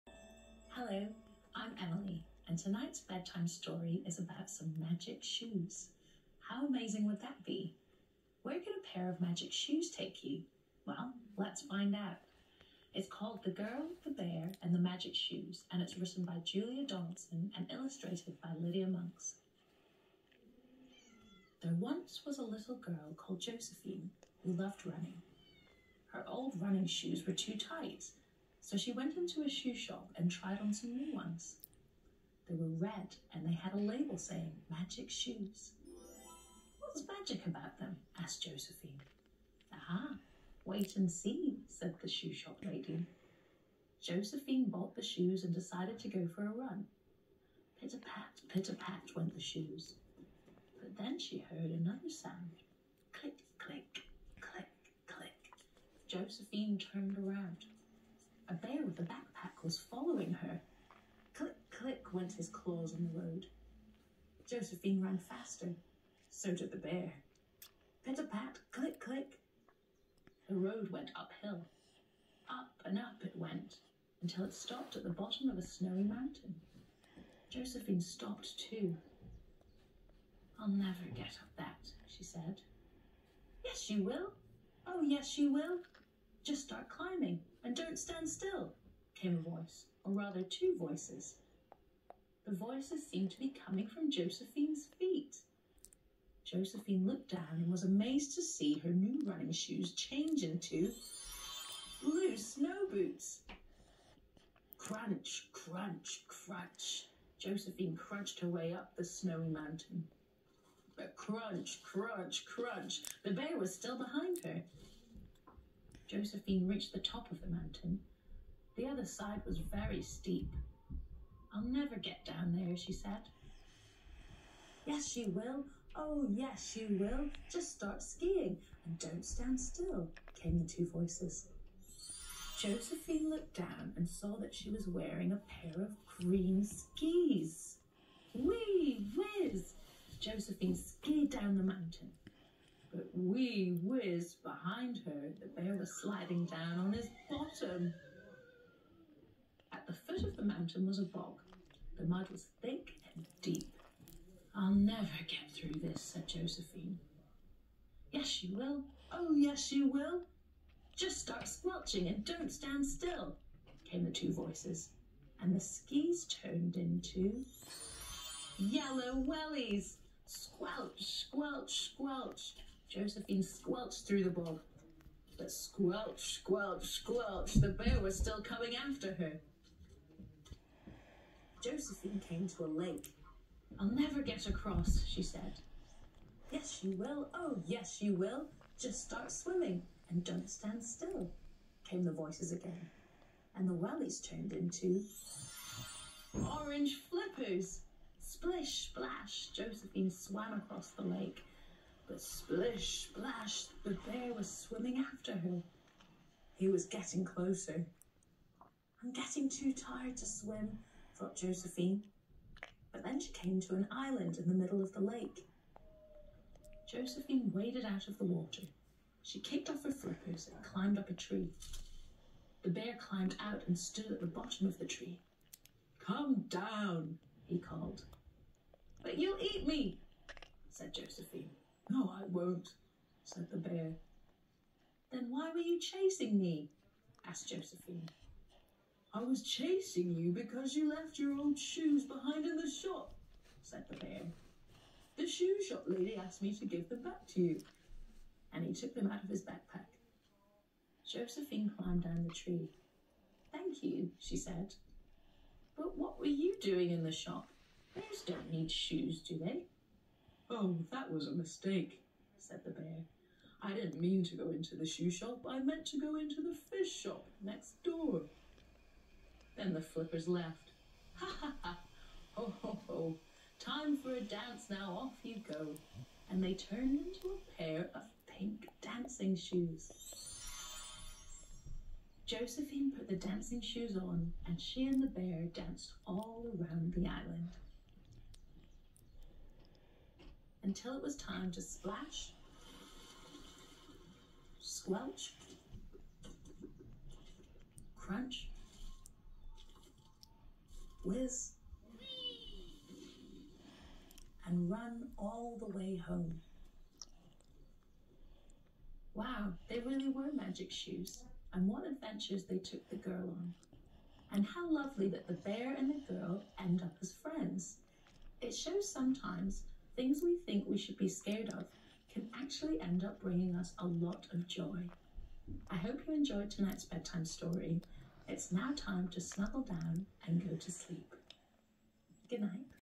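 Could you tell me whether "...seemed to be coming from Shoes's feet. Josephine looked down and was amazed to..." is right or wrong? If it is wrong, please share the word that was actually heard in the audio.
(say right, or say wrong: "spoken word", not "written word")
wrong: "Josephine", not "Shoes".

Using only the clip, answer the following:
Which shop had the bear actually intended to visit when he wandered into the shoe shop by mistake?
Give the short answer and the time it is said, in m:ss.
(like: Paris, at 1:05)
fish shop, at 4:26.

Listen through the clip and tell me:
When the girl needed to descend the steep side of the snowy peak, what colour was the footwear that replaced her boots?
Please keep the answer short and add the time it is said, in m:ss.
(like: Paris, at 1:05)
green, at 2:16.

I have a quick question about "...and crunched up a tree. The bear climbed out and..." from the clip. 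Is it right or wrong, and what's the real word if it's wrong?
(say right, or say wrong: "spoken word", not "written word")
wrong: "climbed", not "crunched".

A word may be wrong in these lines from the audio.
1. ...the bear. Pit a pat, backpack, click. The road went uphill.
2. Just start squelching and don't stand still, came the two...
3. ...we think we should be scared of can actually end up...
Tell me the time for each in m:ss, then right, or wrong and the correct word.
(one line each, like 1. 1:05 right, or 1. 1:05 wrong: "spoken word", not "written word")
1. 1:06 wrong: "click", not "backpack"
2. 2:40 right
3. 5:20 right.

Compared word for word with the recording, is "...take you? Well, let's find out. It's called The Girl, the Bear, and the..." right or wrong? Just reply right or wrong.
right.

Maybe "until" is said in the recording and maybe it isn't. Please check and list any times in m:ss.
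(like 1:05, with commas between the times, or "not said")
1:14, 4:50.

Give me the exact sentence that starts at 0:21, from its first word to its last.
There once was a little girl called Josephine who loved running.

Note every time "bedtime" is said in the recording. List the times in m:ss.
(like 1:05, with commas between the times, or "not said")
0:02, 5:26.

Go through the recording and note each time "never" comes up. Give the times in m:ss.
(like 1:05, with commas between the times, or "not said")
1:20, 2:01, 2:34, 3:03.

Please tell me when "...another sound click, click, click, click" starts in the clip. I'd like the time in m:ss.
0:51.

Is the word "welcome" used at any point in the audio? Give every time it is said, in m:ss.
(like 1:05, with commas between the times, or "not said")
not said.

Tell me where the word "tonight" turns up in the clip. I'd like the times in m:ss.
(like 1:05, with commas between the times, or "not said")
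0:02, 5:26.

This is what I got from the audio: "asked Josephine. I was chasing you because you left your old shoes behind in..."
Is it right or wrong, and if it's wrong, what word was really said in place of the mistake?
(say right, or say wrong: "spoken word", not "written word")
right.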